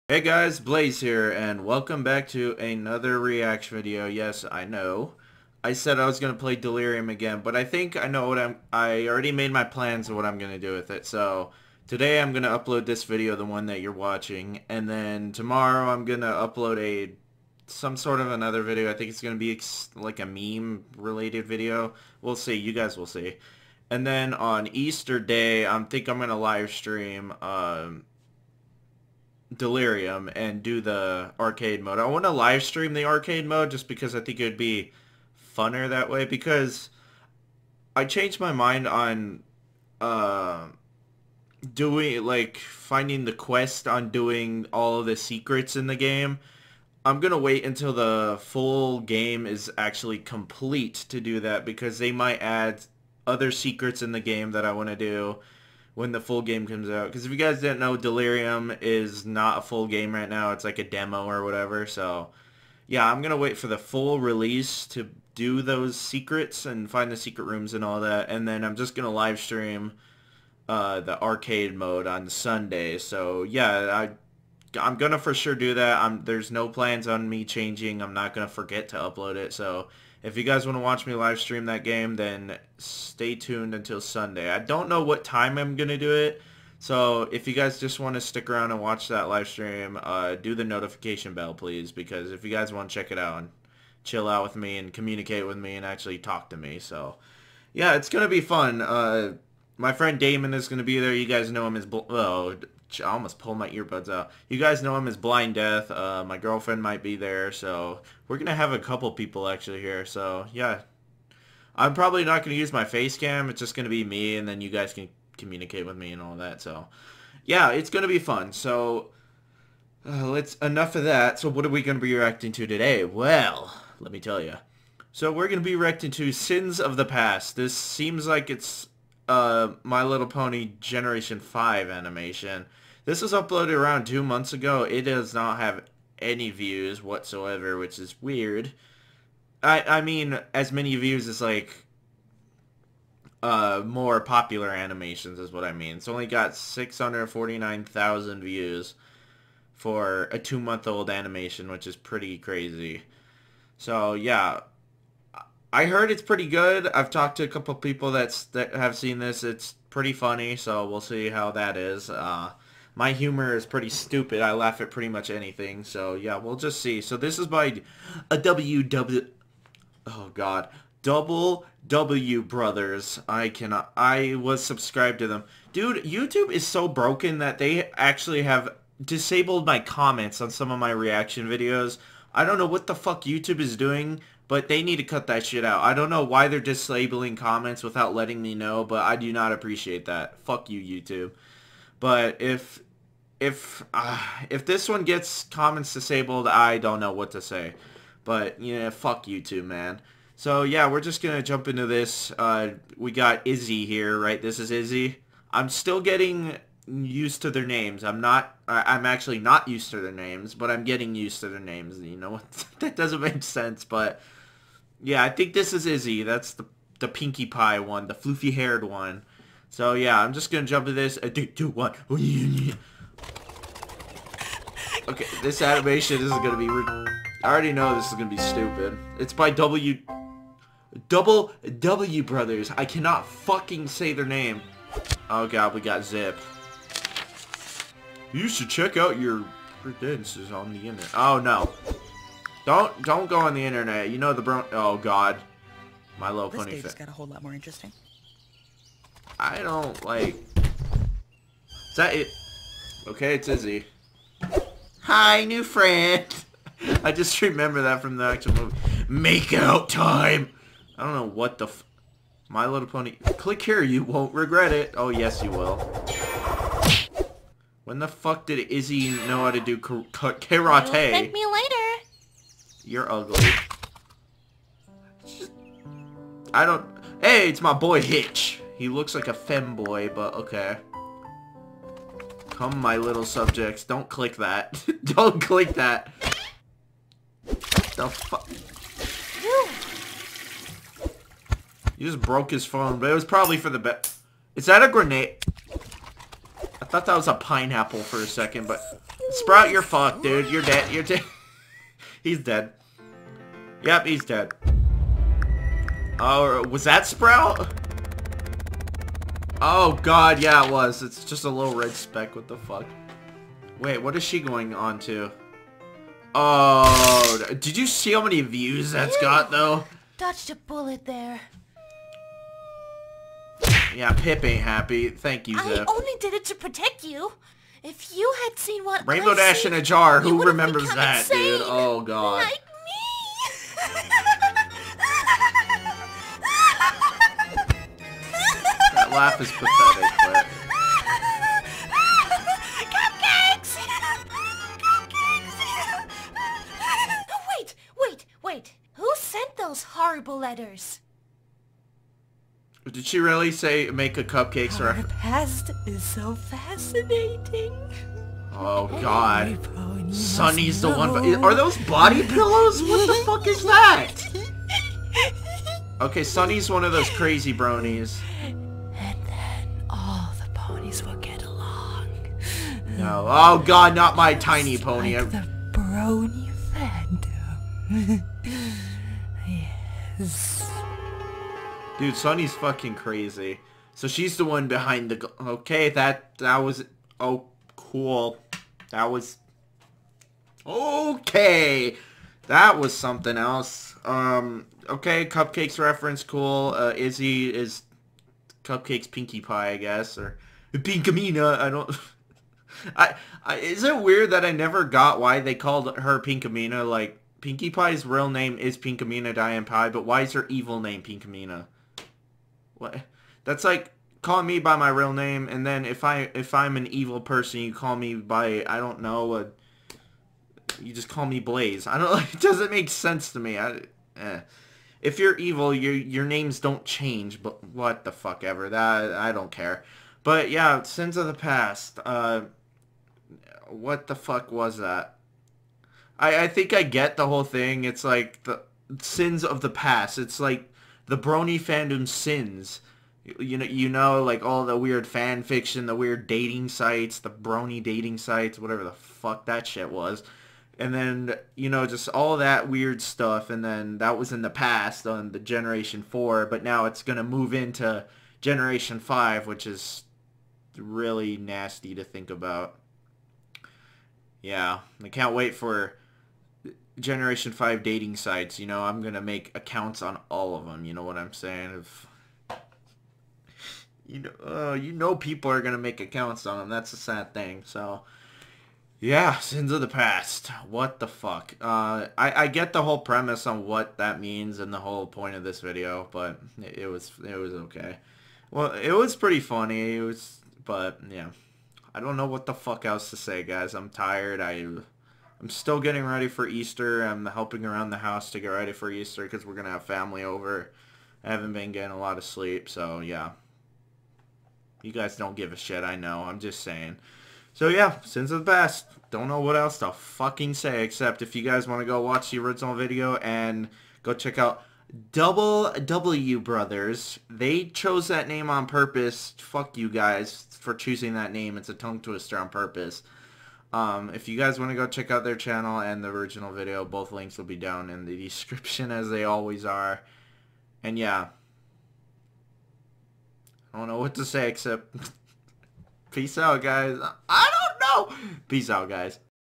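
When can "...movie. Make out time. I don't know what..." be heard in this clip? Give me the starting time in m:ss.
4:18.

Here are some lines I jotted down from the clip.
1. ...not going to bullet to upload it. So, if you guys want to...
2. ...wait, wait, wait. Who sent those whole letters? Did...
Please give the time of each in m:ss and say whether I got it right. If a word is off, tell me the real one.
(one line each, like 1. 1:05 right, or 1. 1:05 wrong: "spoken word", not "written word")
1. 1:18 wrong: "forget", not "bullet"
2. 5:47 wrong: "horrible", not "whole".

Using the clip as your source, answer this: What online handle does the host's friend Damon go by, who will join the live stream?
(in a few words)
Blind Death.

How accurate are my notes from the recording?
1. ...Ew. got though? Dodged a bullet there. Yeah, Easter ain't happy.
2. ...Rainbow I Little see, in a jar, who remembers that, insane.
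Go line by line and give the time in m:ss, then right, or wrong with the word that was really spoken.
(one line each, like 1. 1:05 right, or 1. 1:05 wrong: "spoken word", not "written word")
1. 5:19 wrong: "Pipp", not "Easter"
2. 5:29 wrong: "Dash", not "Little".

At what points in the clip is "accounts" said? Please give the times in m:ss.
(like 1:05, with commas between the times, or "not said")
7:49, 7:55.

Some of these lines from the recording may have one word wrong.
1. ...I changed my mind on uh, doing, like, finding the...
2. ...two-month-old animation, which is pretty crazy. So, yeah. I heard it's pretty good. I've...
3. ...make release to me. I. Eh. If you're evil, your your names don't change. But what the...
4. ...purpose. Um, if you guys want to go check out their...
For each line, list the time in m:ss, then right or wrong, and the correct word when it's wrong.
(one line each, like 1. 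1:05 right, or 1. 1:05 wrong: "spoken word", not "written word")
1. 0:37 right
2. 2:30 right
3. 7:02 wrong: "sense", not "release"
4. 8:42 right.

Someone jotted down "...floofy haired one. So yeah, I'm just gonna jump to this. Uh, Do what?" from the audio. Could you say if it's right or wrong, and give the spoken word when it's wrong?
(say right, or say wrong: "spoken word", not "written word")
right.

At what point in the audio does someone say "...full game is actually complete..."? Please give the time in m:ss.
0:48.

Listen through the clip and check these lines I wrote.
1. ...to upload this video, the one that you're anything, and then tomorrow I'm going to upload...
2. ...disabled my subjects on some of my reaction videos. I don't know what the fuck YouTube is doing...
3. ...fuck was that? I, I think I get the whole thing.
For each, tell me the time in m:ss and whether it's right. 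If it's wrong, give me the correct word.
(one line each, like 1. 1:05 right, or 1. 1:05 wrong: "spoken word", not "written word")
1. 0:12 wrong: "watching", not "anything"
2. 2:59 wrong: "comments", not "subjects"
3. 7:14 right.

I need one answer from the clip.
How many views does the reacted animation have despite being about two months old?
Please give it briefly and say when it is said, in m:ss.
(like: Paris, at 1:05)
649,000, at 2:26.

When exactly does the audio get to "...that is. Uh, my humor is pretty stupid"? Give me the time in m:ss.
2:41.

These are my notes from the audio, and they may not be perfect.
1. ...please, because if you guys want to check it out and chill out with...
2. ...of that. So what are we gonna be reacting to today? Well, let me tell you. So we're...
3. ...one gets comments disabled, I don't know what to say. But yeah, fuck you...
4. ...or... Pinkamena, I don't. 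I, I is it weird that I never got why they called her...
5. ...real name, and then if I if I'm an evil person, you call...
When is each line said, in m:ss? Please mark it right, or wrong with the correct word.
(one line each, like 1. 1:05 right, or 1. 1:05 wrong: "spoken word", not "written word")
1. 1:31 right
2. 2:00 right
3. 3:14 right
4. 6:40 right
5. 6:54 right.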